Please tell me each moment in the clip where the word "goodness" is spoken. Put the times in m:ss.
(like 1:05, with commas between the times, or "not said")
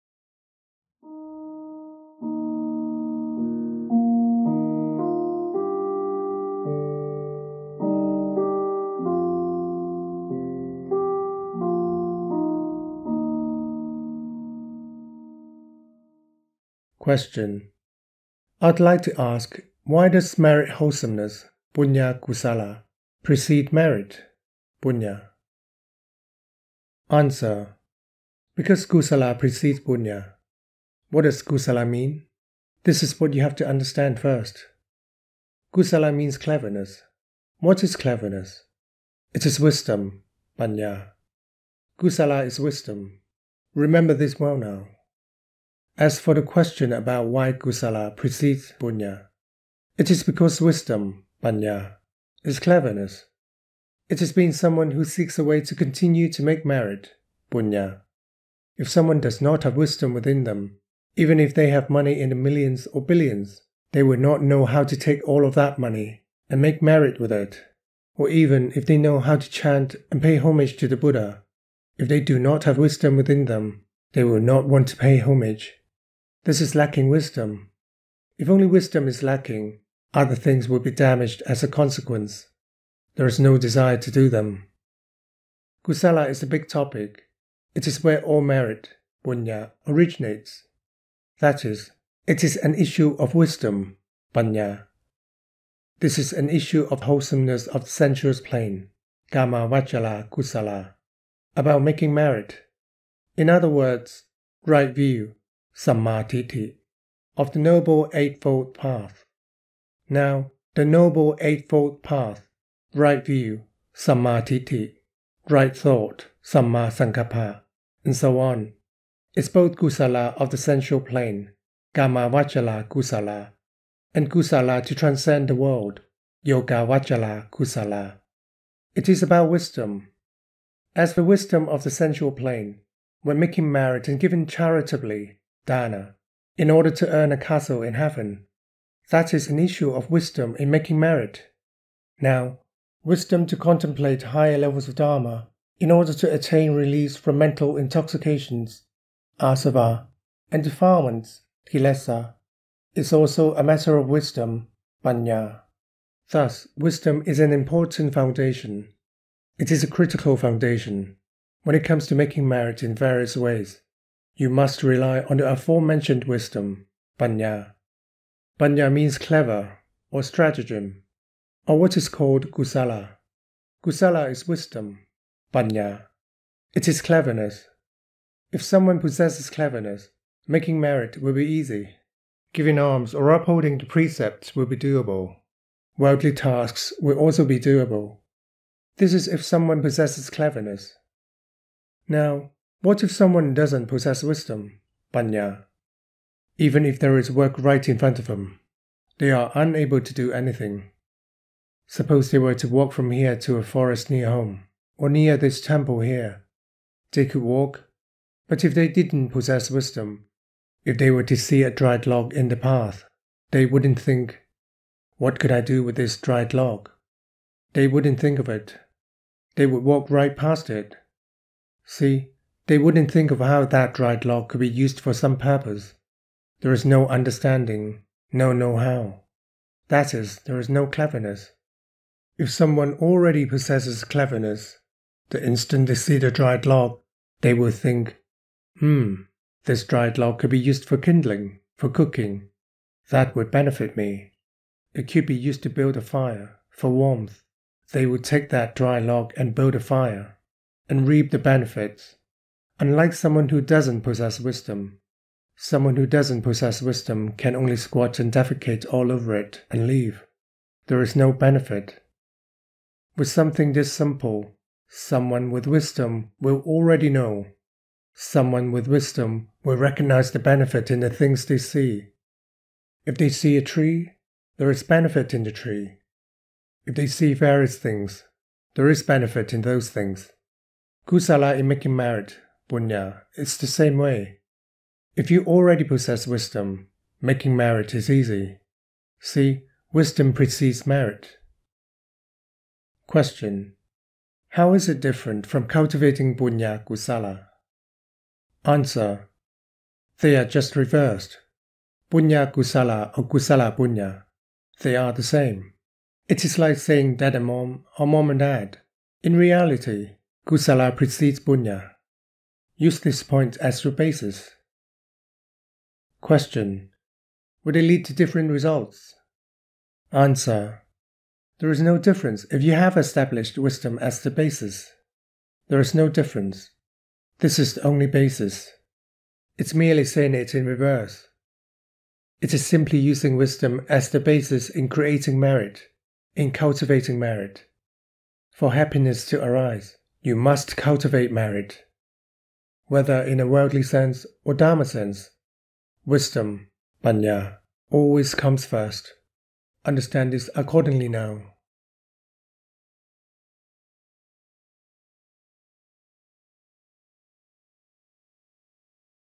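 not said.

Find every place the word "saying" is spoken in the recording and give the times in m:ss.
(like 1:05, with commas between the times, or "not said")
5:06, 5:30.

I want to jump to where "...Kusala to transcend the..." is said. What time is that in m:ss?
2:04.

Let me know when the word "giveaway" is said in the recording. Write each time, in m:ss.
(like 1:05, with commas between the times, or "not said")
not said.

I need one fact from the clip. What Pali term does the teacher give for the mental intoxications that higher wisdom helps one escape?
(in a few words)
asava.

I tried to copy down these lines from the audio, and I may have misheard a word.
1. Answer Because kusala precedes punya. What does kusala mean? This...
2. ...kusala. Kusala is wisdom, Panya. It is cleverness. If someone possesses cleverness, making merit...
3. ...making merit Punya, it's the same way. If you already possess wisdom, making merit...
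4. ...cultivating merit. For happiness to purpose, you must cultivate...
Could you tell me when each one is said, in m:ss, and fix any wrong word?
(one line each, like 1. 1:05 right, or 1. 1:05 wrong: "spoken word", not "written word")
1. 0:27 right
2. 2:52 right
3. 4:41 right
4. 5:36 wrong: "arise", not "purpose".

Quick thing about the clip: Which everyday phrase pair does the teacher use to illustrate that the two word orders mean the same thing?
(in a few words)
dad and mom.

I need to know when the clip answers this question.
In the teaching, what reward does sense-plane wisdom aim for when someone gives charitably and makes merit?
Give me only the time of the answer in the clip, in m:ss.
2:17.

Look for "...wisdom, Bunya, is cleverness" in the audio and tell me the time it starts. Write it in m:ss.
0:50.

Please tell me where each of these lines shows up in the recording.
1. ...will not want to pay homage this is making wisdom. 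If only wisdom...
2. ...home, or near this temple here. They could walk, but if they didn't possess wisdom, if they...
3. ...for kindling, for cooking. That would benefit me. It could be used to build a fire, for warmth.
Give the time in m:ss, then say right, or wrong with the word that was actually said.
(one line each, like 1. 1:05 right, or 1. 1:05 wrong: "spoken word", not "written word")
1. 1:14 wrong: "lacking", not "making"
2. 3:24 right
3. 4:00 right.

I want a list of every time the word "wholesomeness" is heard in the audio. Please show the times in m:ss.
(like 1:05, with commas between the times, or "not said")
0:20, 1:37.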